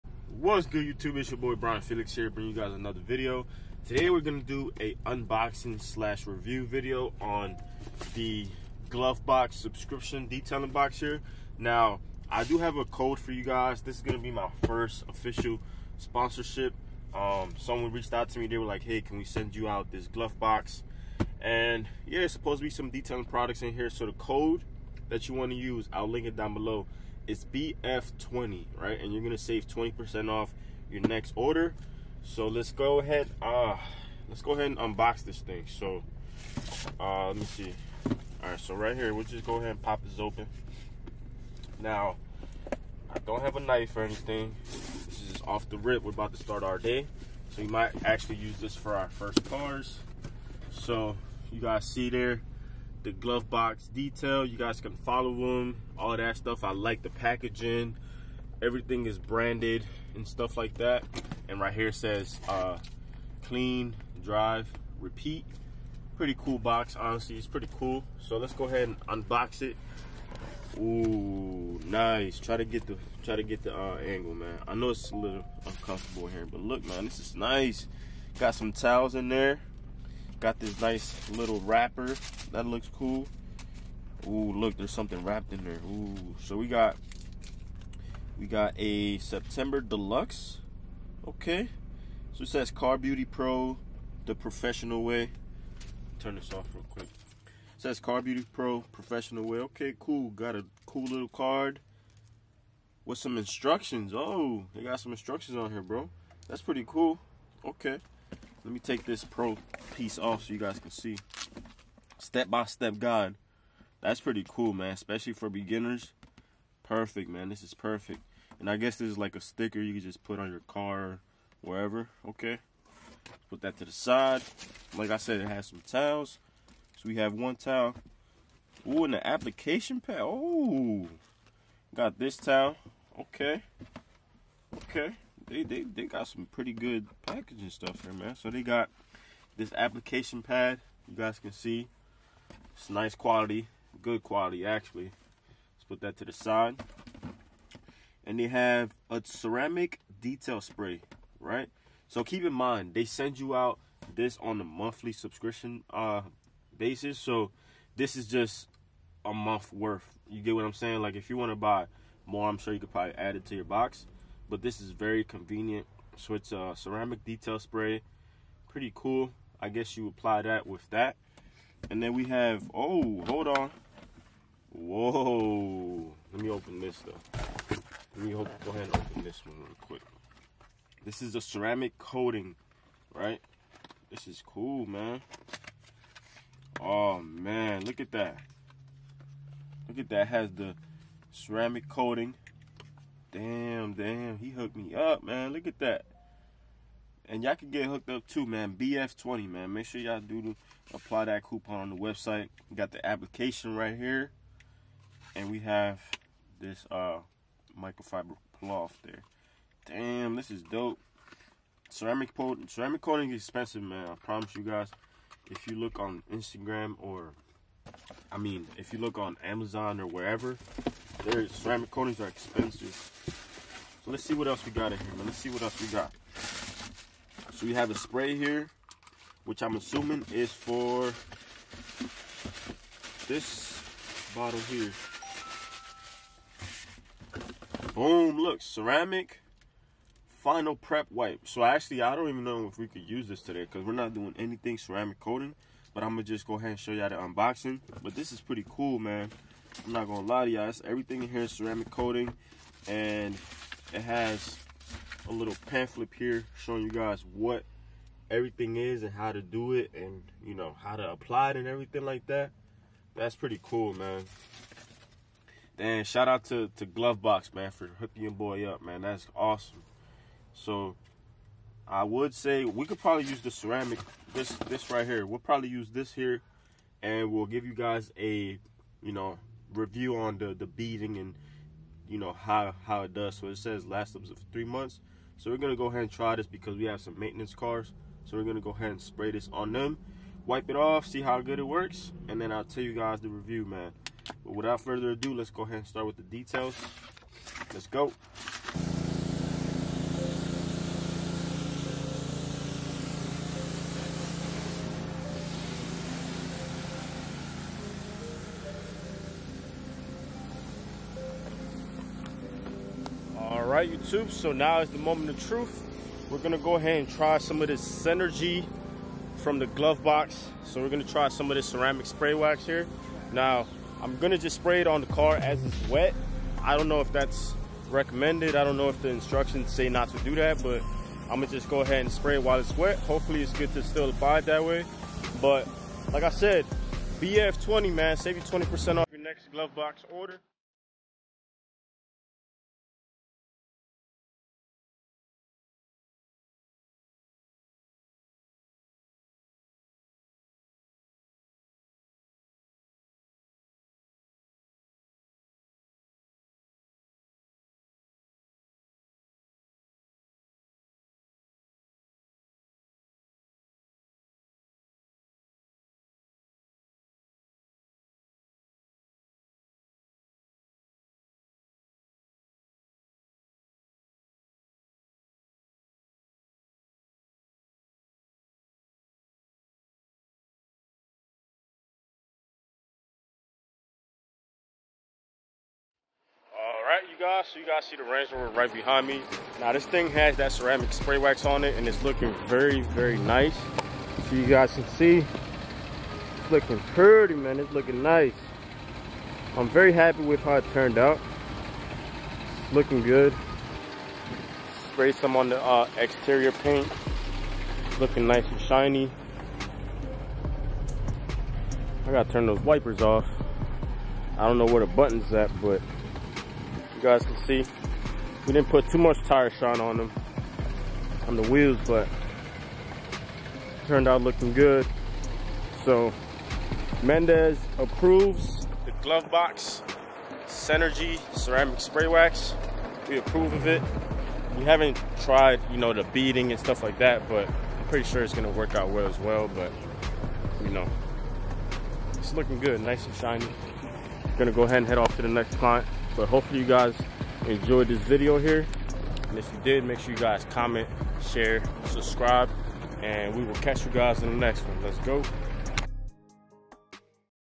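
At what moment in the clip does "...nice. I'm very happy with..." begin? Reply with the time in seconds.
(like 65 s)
398 s.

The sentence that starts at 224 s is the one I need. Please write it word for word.
So let's see what else we got in here, man.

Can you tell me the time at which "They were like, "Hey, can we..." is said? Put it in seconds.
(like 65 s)
18 s.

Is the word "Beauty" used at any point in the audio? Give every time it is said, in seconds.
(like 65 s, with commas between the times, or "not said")
92 s, 98 s.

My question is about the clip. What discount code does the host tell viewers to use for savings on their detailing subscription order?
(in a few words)
BF20.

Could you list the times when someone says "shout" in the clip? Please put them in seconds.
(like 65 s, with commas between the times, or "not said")
266 s.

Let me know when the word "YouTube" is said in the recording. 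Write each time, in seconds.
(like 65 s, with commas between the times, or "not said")
0 s, 313 s.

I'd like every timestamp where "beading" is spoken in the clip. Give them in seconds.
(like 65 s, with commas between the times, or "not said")
280 s, 436 s.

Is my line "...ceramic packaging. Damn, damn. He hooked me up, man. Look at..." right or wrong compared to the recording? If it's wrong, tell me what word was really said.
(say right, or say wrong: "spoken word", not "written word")
wrong: "coating", not "packaging".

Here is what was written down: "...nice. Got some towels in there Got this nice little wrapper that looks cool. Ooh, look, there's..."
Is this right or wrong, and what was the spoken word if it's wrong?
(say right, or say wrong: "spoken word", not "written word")
right.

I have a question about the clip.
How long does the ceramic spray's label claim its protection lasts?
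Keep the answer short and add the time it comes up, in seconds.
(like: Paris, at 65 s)
3 months, at 284 s.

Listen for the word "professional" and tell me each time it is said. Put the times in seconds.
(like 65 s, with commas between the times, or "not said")
94 s, 98 s.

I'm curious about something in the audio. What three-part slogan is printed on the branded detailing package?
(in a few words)
Clean, drive, repeat.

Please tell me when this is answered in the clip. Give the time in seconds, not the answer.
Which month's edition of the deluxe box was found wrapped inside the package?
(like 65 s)
89 s.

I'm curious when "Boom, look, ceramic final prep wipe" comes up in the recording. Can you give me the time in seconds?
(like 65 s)
237 s.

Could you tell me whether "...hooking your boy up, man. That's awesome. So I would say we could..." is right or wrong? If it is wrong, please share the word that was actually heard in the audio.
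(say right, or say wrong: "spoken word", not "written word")
right.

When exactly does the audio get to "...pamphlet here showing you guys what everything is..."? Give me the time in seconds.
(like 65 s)
255 s.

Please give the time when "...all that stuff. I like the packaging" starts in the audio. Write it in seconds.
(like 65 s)
55 s.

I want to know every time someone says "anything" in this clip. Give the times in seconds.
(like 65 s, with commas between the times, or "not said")
44 s, 244 s.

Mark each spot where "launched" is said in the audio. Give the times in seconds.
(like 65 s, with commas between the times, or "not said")
not said.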